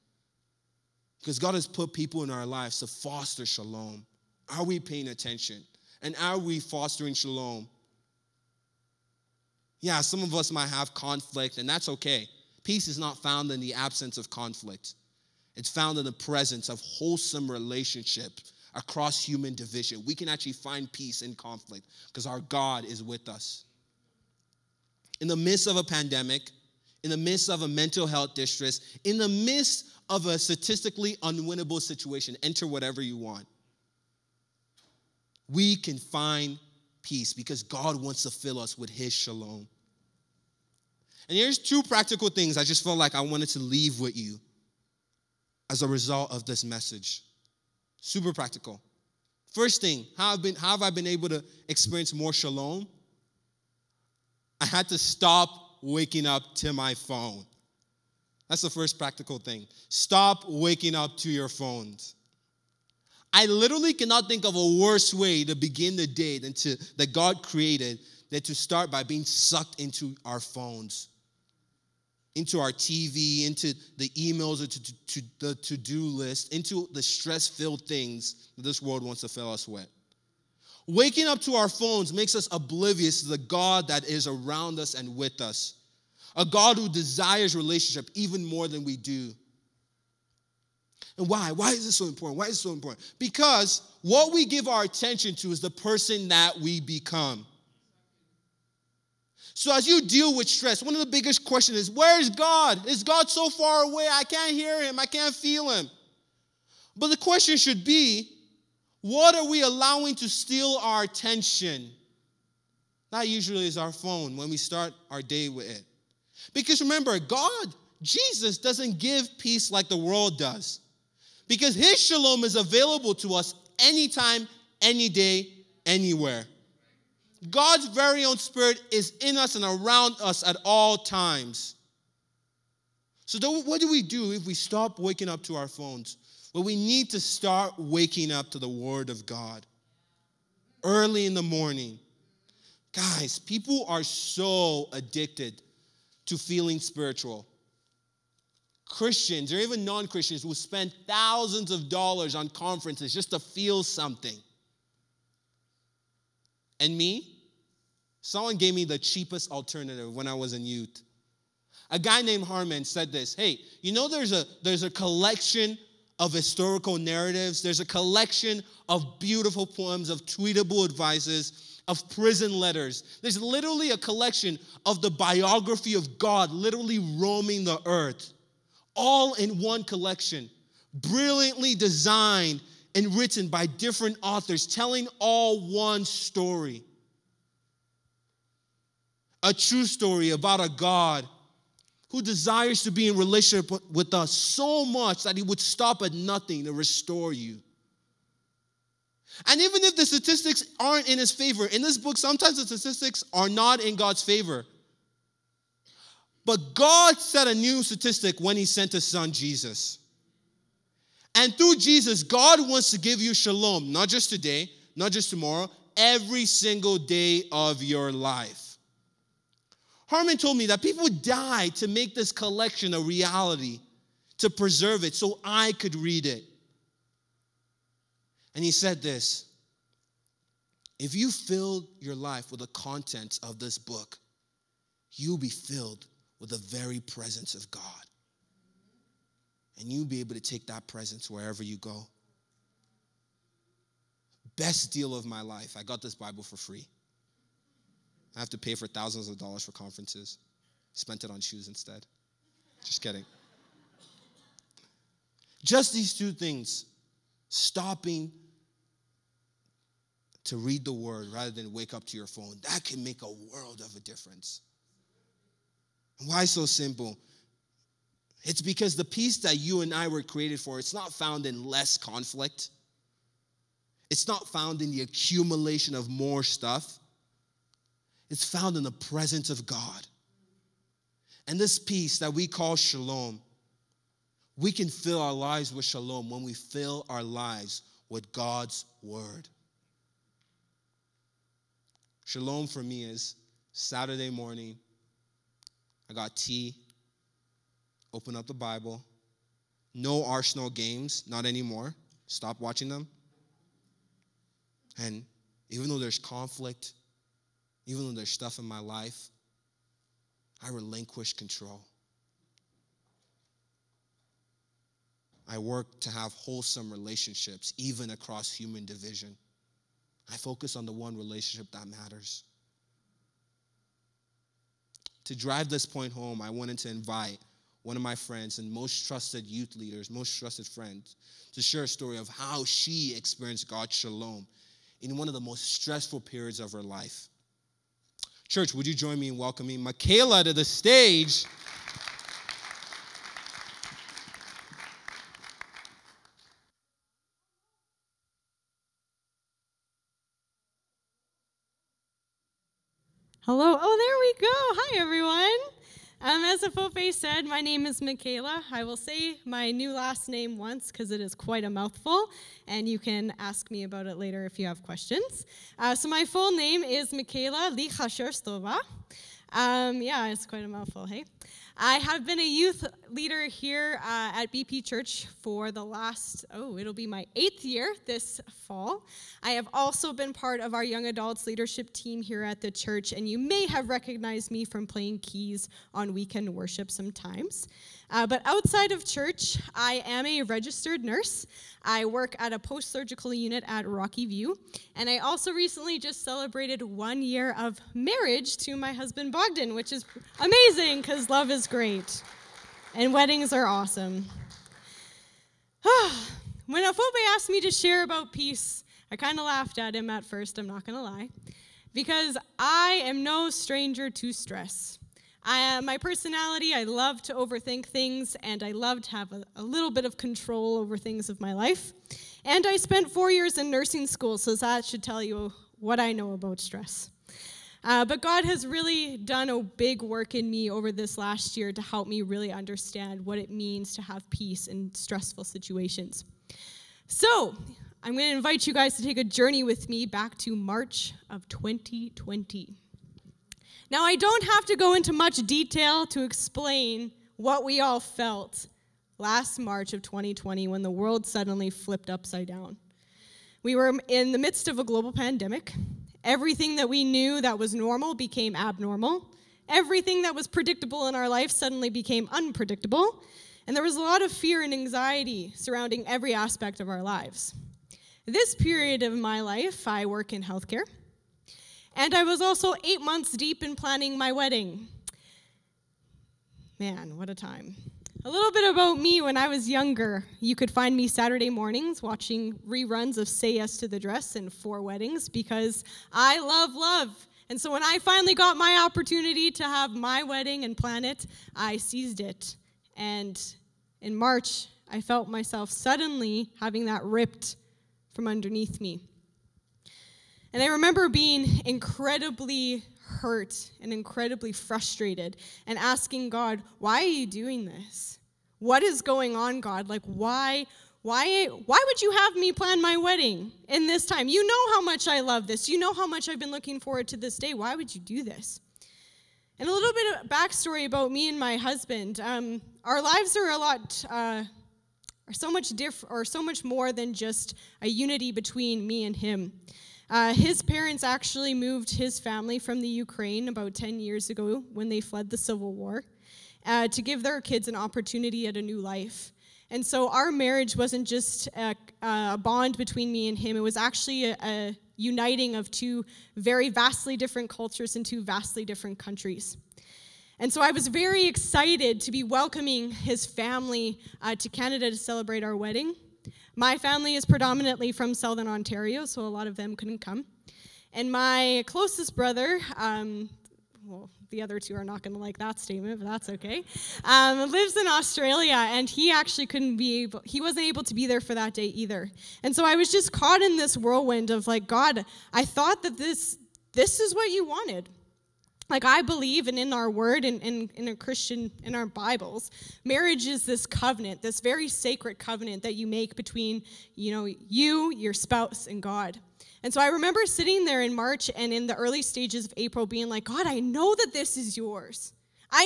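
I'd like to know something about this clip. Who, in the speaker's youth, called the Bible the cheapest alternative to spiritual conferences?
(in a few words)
Harman.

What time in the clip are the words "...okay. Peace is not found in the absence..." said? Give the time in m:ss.
0:11.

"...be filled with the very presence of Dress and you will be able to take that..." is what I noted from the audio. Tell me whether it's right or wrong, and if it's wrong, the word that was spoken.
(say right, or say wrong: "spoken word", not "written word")
wrong: "God", not "Dress".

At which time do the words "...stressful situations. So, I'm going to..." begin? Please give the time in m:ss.
7:14.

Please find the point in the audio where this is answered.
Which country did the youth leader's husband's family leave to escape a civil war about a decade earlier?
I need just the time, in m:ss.
8:52.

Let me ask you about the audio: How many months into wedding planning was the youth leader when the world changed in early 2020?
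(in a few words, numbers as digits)
8.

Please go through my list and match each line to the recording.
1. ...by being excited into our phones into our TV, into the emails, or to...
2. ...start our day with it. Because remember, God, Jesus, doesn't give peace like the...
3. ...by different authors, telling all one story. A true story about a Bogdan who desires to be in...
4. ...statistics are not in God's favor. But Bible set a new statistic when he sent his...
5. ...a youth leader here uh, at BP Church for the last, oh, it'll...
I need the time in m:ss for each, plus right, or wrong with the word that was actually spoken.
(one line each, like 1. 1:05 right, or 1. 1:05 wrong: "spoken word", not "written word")
1. 1:08 wrong: "sucked", not "excited"
2. 1:54 right
3. 3:03 wrong: "God", not "Bogdan"
4. 3:22 wrong: "God", not "Bible"
5. 6:12 right.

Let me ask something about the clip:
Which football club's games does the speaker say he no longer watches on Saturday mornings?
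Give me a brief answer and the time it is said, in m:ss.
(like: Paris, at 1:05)
Arsenal, at 5:00.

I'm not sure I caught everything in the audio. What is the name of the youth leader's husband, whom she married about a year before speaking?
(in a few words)
Bogdan.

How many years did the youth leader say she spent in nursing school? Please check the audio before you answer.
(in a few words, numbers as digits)
4.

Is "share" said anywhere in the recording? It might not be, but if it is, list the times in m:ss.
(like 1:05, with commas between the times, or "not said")
5:31, 6:47.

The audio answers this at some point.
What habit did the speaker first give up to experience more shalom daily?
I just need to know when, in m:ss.
0:54.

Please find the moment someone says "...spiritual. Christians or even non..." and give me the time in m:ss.
2:26.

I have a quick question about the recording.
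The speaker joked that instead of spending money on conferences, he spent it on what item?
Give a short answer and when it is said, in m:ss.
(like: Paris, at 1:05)
Shoes, at 4:11.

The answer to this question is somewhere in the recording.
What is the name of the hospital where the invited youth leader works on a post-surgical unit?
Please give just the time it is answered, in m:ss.
6:33.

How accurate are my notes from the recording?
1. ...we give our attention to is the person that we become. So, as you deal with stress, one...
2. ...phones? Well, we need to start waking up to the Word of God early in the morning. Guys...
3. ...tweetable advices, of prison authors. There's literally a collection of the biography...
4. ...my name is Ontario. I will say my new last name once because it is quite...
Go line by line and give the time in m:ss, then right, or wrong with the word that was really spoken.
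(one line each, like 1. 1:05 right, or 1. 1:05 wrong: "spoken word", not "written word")
1. 1:34 right
2. 2:15 right
3. 2:50 wrong: "letters", not "authors"
4. 5:57 wrong: "Michaela", not "Ontario".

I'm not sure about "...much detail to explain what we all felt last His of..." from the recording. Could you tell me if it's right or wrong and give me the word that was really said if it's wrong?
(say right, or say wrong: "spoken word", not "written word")
wrong: "March", not "His".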